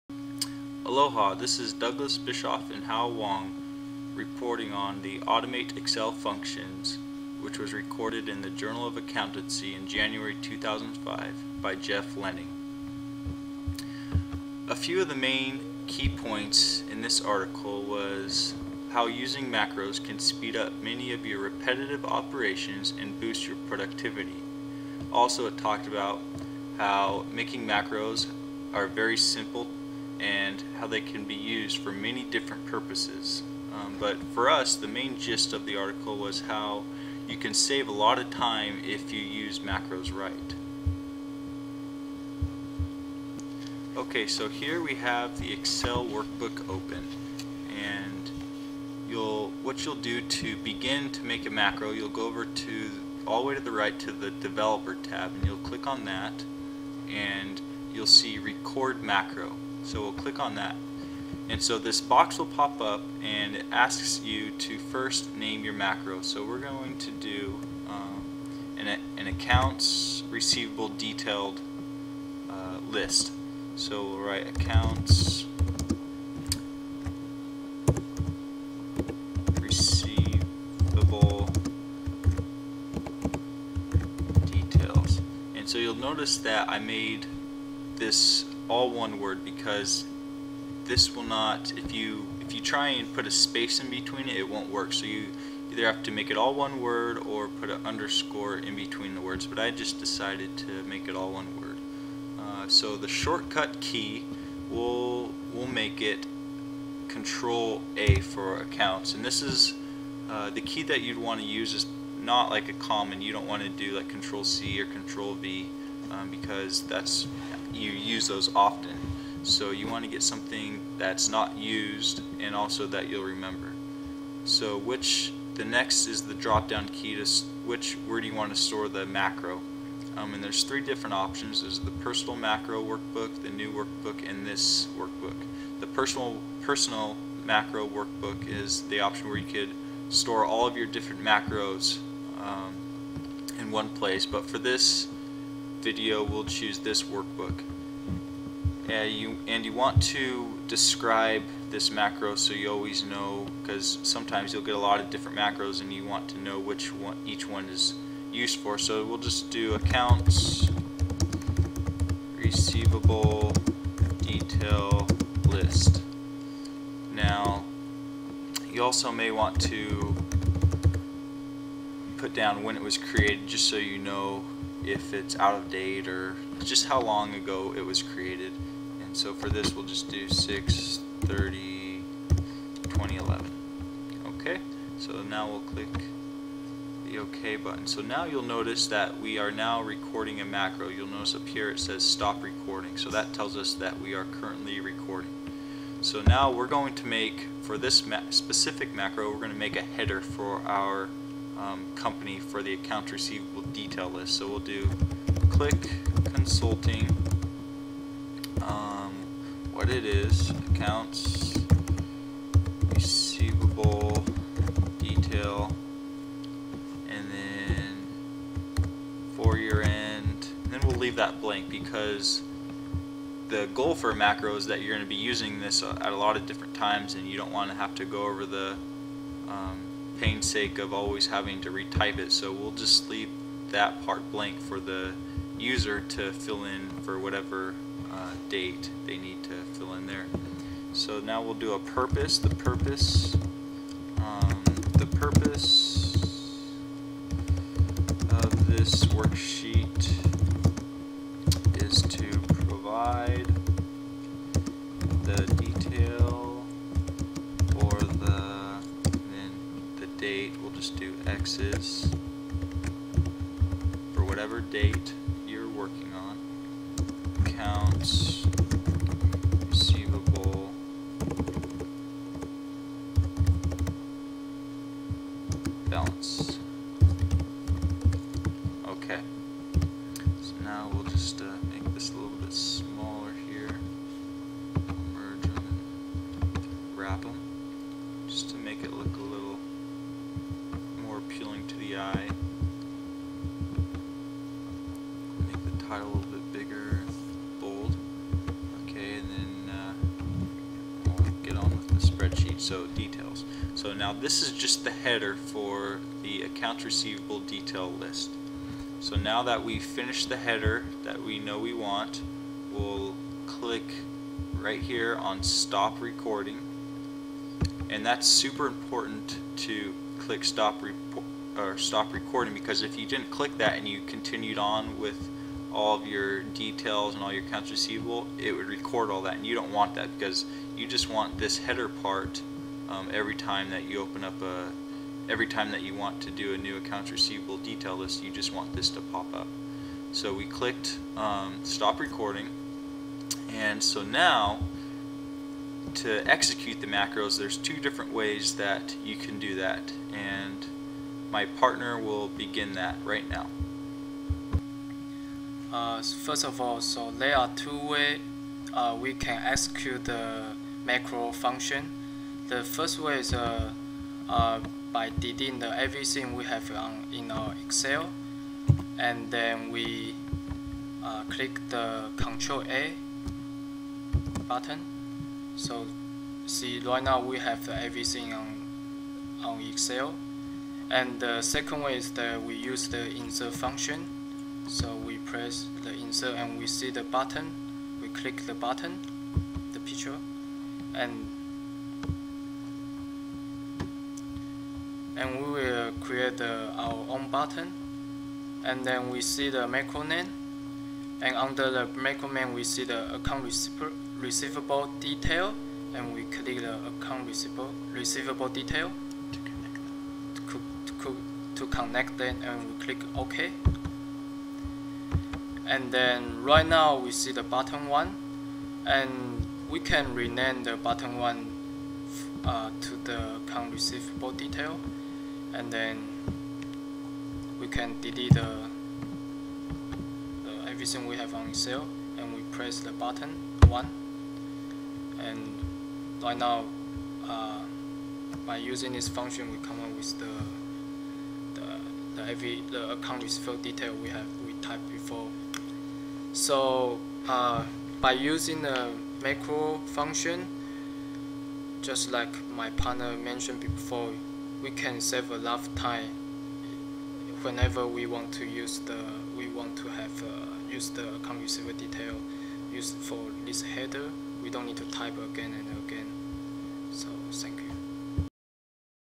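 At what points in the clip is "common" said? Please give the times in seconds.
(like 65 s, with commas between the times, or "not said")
112 s.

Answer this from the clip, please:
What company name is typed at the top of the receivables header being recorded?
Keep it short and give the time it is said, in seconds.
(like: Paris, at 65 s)
Click Consulting, at 205 s.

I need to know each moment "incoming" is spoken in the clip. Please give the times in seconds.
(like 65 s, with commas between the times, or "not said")
not said.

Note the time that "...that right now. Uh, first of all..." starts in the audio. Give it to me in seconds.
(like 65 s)
352 s.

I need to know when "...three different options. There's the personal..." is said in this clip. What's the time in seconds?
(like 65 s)
130 s.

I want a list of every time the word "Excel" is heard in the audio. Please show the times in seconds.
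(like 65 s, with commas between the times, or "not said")
5 s, 45 s, 367 s, 379 s, 431 s.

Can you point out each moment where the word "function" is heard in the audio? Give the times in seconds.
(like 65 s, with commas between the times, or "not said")
6 s, 361 s, 383 s, 439 s, 449 s.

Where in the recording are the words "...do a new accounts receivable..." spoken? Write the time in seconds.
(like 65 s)
336 s.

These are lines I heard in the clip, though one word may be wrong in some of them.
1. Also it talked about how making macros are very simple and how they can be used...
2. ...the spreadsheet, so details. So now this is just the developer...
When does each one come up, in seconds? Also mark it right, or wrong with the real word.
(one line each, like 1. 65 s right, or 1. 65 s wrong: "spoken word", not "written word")
1. 25 s right
2. 301 s wrong: "header", not "developer".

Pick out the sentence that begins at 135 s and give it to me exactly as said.
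The personal personal macro workbook is the option where you could store all of your different macros um, in one place.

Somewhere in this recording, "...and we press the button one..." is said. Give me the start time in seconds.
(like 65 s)
432 s.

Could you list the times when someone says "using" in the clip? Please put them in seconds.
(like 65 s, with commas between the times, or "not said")
19 s, 225 s, 438 s, 448 s.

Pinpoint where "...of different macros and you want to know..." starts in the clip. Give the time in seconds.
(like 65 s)
154 s.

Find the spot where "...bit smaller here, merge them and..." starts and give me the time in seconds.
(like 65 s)
282 s.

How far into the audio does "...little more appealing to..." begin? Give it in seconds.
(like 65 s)
289 s.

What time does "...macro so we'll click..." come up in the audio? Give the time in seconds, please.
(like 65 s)
59 s.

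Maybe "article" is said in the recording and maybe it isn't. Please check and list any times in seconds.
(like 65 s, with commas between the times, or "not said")
17 s, 35 s.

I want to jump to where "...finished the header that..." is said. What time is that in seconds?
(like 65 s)
309 s.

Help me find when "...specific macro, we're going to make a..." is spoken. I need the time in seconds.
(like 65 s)
198 s.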